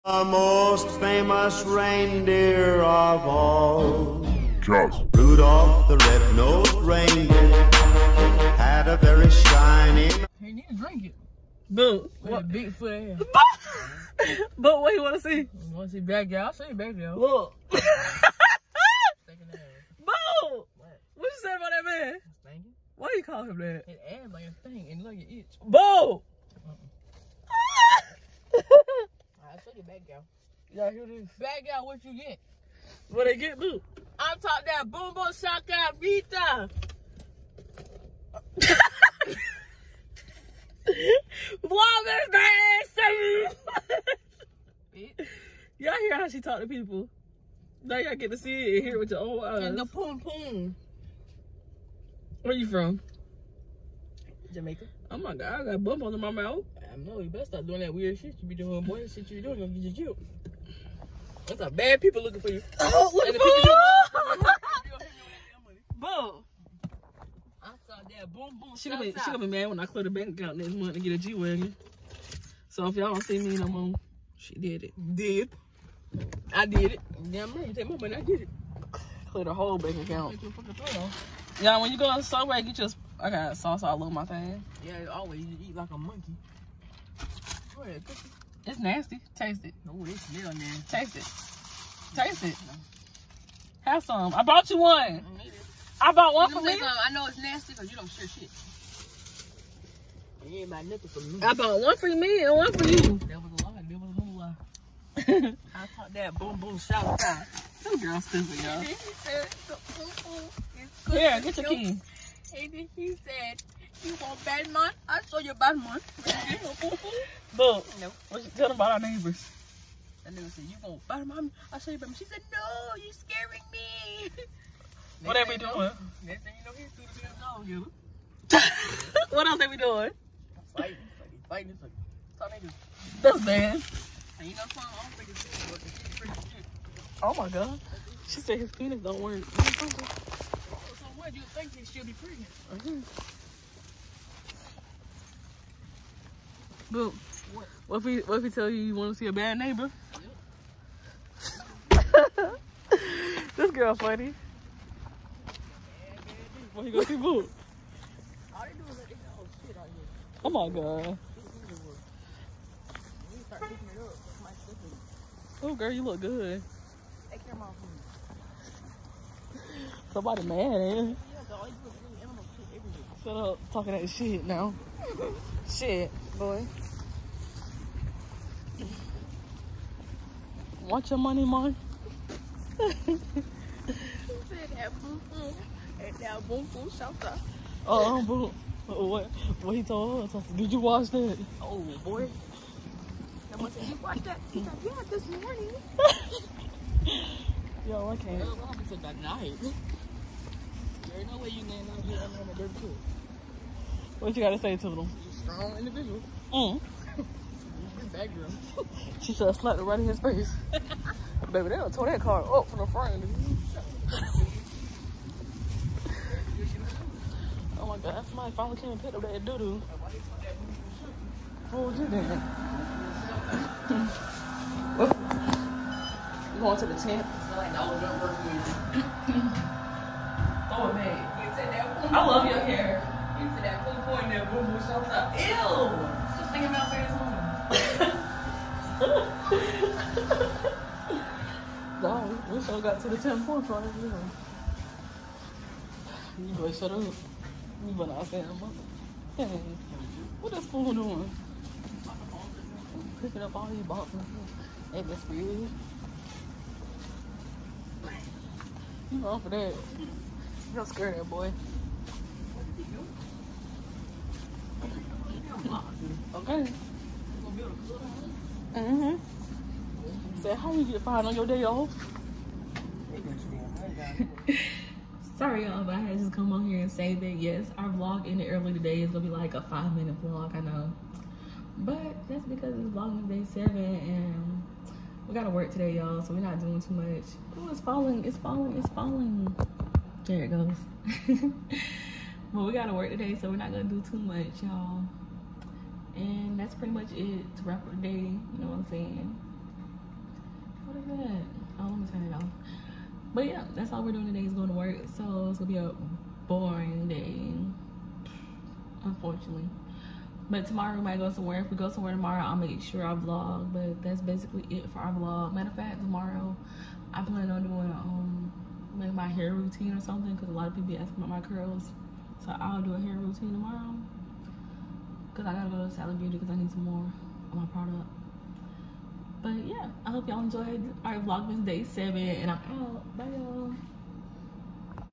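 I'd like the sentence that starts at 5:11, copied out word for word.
If we go somewhere tomorrow, I'll make sure I vlog.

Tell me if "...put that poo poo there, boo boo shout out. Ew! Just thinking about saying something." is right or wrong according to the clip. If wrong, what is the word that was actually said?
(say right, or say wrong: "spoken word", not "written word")
right.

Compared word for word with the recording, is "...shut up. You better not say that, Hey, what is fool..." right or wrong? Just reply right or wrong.
right.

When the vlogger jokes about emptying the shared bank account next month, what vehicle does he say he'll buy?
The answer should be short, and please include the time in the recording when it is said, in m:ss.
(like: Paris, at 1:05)
G Wagon, at 1:11.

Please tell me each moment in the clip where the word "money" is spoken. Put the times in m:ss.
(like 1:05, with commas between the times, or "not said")
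1:17, 3:01.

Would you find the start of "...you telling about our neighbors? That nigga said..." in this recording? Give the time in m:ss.
1:58.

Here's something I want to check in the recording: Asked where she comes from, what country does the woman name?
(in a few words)
Jamaica.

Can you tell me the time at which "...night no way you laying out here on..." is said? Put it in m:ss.
3:19.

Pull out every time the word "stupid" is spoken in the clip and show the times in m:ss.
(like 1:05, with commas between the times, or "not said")
1:48.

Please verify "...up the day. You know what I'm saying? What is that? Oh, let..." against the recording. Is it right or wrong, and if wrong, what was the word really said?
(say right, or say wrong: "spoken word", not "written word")
right.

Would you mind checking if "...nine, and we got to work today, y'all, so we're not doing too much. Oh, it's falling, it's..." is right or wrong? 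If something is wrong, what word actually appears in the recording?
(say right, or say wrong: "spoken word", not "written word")
wrong: "seven", not "nine".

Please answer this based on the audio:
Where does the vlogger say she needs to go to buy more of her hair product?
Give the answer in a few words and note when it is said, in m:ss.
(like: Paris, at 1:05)
Sally Beauty, at 5:25.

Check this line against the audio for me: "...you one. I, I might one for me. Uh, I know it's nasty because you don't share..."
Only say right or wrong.
wrong.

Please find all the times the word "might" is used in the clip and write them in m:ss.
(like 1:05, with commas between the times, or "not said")
5:11.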